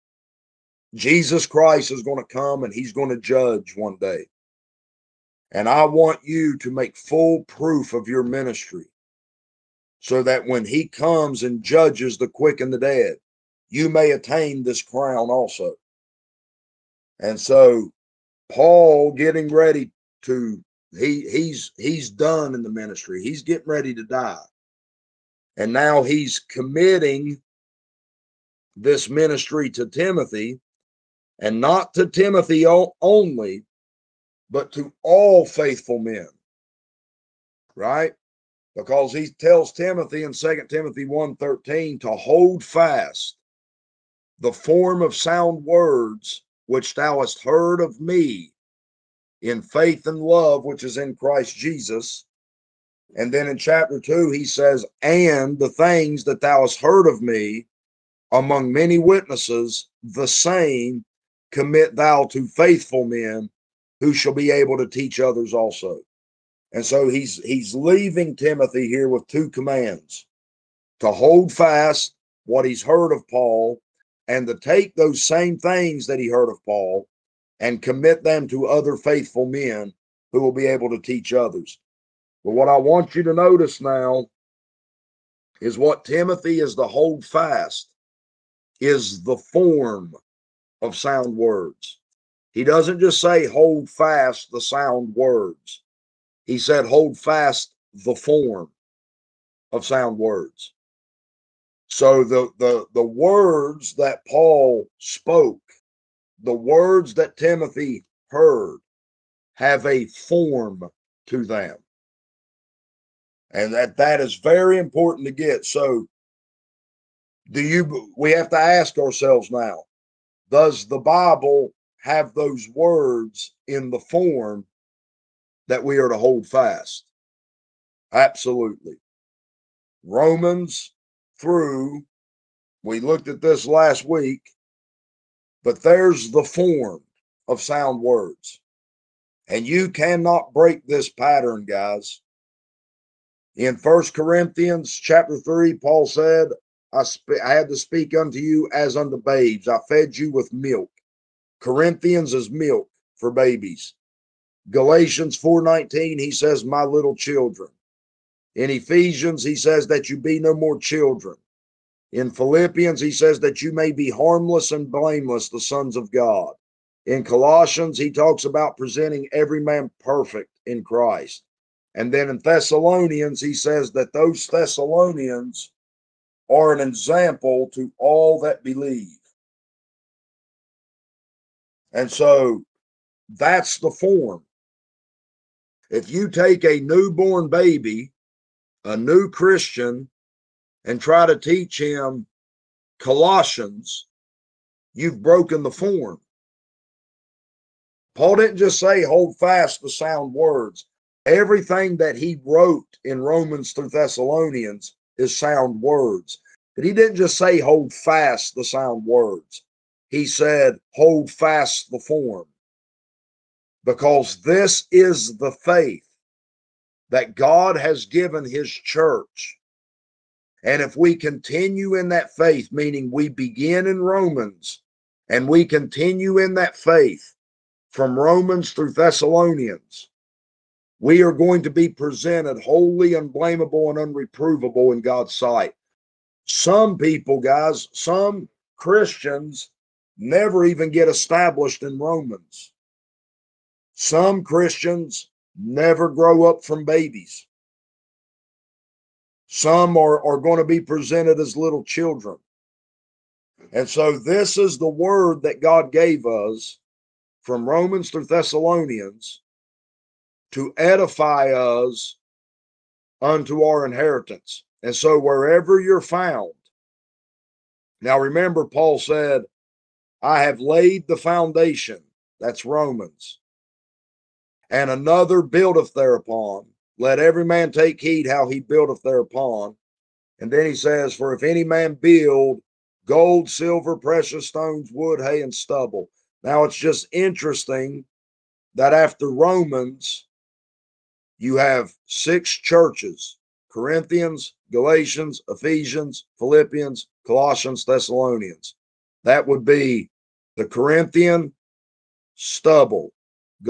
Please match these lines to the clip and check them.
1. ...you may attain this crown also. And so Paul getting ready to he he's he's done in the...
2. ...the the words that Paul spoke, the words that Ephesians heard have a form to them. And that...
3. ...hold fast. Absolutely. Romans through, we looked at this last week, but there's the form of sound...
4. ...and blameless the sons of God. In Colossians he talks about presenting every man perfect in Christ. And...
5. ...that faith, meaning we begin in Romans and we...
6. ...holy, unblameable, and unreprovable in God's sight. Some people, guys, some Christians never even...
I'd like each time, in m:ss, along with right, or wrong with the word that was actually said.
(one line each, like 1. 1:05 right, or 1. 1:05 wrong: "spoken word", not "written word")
1. 0:13 right
2. 1:42 wrong: "Timothy", not "Ephesians"
3. 2:06 right
4. 2:44 right
5. 3:42 right
6. 3:52 right.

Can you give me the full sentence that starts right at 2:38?
In Ephesians he says that you be no more children.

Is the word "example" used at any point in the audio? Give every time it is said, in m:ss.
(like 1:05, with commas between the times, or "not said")
2:56.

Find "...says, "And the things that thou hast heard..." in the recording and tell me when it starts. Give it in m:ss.
0:54.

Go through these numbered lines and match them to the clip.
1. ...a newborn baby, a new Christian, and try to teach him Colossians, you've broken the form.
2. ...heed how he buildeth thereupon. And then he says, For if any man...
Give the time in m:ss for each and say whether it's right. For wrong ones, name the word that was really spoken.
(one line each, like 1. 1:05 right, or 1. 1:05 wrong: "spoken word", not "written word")
1. 3:06 right
2. 4:37 right.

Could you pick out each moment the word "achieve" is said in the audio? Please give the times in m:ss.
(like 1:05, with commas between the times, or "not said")
not said.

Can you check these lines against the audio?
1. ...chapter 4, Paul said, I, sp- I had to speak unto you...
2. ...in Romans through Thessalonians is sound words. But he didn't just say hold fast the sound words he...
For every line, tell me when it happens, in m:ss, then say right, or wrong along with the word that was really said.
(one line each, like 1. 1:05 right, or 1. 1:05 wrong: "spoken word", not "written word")
1. 2:24 wrong: "3", not "4"
2. 3:23 right.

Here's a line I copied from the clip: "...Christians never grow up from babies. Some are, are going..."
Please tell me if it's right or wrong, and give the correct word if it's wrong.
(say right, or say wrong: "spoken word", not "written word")
right.